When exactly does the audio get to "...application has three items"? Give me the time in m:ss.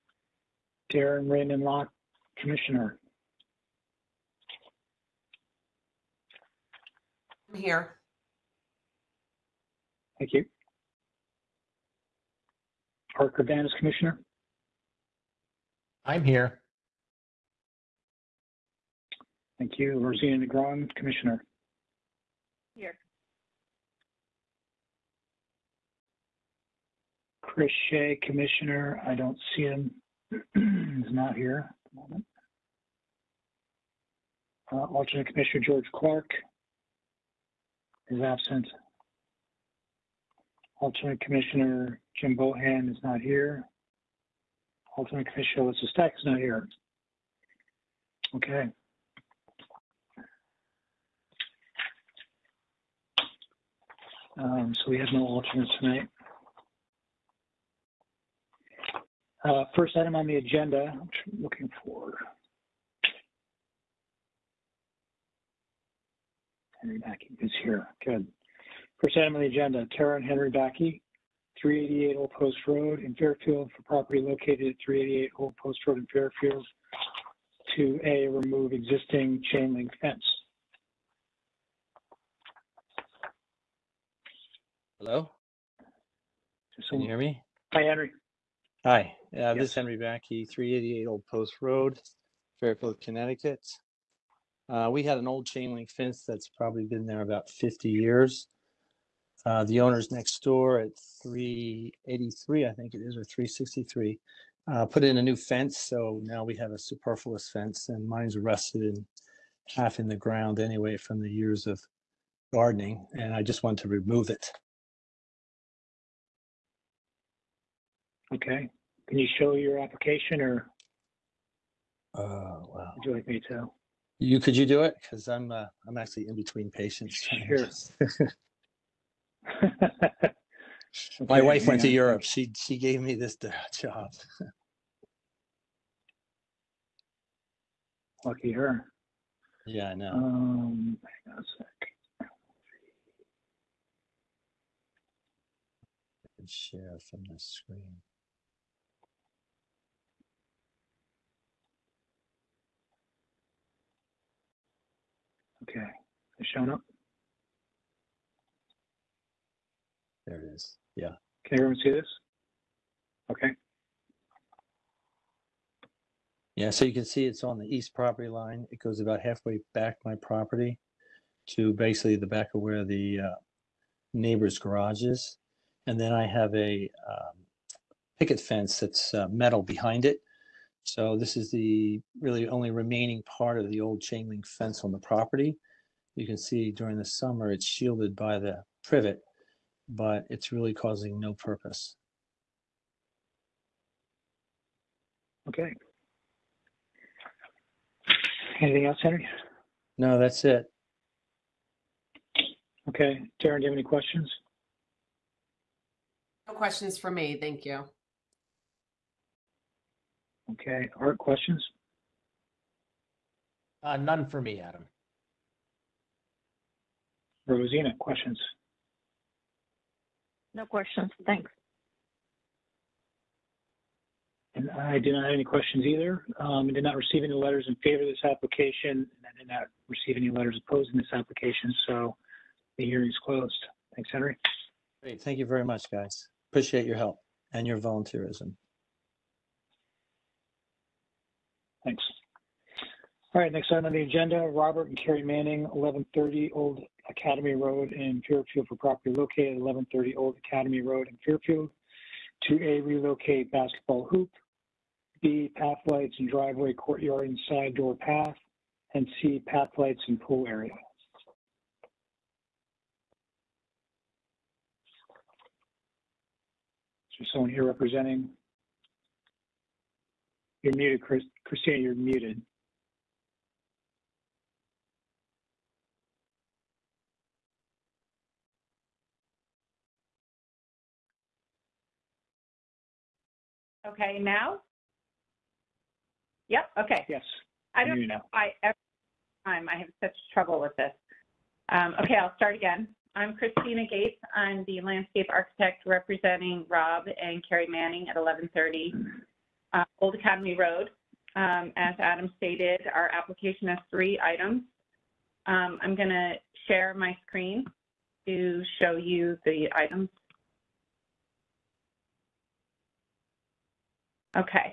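5:03.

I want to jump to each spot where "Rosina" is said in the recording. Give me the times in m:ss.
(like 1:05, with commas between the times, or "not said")
0:19, 3:37.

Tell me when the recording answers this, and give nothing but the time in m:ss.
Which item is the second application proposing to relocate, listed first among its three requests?
4:13.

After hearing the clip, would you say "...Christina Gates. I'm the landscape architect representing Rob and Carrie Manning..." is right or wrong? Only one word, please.
right.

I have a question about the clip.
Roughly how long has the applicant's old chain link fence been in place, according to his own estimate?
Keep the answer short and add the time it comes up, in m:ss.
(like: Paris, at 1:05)
50 years, at 1:37.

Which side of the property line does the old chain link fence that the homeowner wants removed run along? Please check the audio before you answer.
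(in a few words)
east.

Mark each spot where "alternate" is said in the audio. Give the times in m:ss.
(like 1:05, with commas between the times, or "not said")
0:34, 0:40, 0:44, 0:55.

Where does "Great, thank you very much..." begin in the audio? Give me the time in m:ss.
3:55.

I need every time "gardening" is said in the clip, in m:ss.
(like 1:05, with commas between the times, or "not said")
1:52.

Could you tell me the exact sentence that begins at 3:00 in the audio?
So this is the really only remaining part of the old chain link fence on the property.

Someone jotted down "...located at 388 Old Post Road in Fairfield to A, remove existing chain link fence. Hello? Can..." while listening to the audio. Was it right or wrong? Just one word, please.
right.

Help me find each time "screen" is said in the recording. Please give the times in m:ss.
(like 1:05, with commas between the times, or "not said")
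2:27, 5:07.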